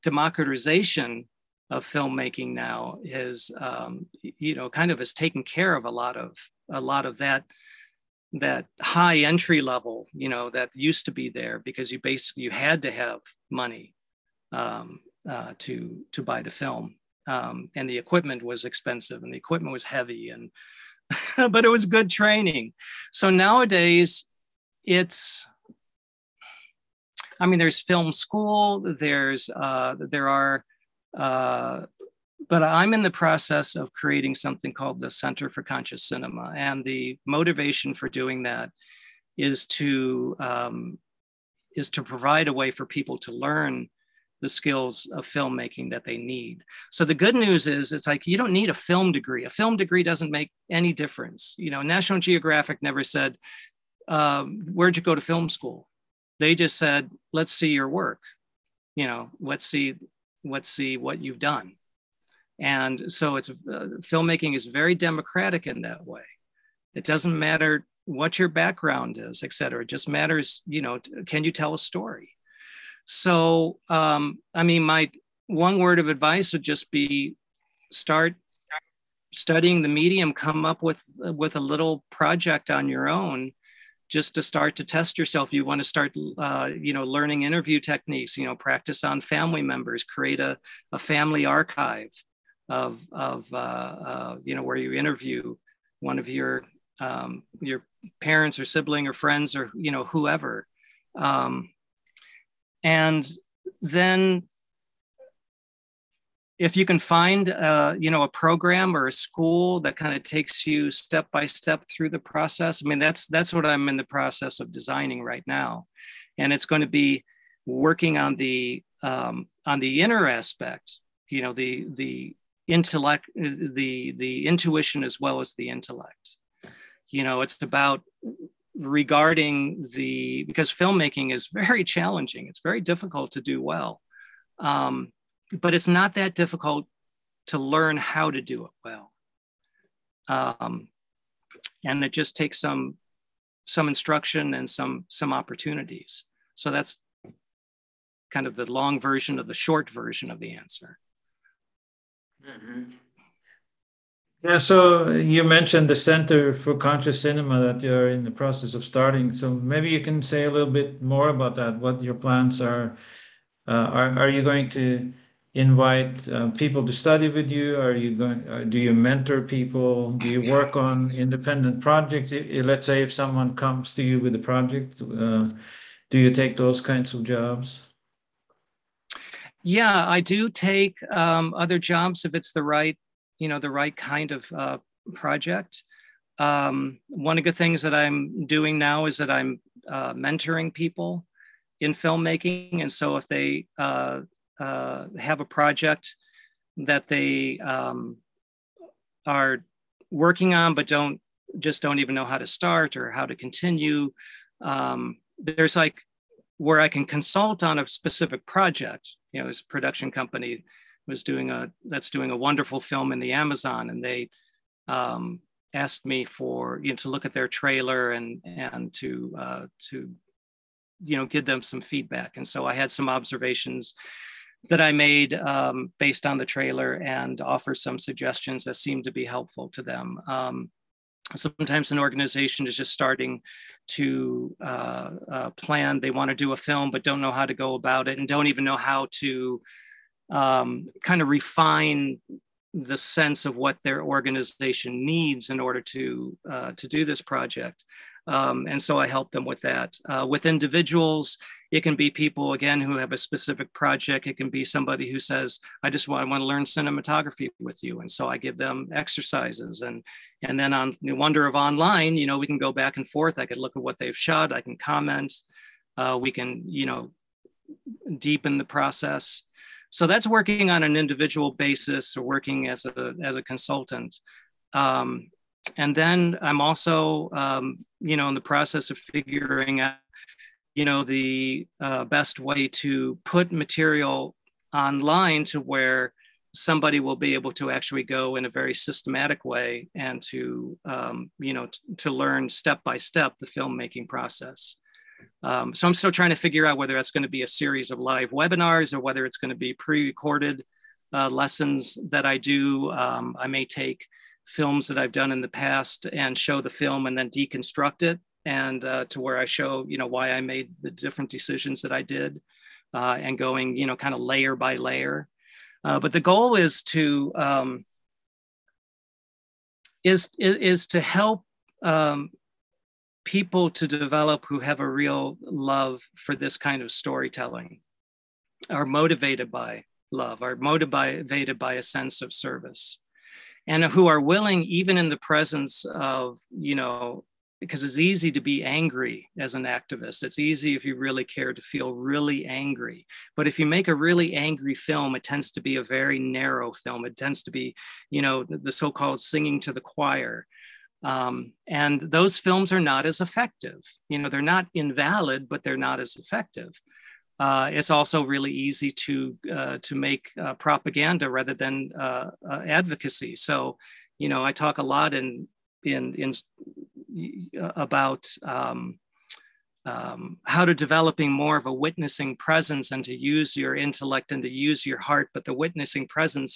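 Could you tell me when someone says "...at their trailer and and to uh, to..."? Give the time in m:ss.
3:37.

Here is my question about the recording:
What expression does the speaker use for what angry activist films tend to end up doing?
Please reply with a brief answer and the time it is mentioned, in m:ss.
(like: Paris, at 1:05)
Singing to the choir, at 5:49.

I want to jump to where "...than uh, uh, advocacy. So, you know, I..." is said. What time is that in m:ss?
6:01.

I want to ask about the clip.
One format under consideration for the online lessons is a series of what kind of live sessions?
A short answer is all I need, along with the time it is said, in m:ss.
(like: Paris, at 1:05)
Live webinars, at 4:57.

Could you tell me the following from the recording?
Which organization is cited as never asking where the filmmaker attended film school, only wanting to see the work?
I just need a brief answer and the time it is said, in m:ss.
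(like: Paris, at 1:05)
National Geographic, at 0:51.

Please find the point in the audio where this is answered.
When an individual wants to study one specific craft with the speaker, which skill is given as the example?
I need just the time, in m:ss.
4:16.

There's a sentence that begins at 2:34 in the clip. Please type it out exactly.
Yeah, so you mentioned the Center for Conscious Cinema that you're in the process of starting.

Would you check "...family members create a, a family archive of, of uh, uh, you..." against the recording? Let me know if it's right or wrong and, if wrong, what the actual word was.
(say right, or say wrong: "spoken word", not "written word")
right.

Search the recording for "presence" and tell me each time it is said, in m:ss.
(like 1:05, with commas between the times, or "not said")
5:35, 6:12.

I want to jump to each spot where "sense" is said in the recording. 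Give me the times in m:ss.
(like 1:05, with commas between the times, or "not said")
4:02, 5:31.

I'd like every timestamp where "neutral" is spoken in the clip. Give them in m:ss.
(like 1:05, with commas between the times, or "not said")
not said.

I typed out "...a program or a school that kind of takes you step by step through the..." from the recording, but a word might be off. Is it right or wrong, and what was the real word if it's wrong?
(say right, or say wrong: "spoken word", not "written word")
right.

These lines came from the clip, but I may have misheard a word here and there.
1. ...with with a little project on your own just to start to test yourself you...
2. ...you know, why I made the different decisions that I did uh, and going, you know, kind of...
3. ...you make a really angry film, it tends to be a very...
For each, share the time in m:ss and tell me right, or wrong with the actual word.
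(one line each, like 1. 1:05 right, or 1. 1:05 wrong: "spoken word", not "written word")
1. 1:20 right
2. 5:09 right
3. 5:43 right.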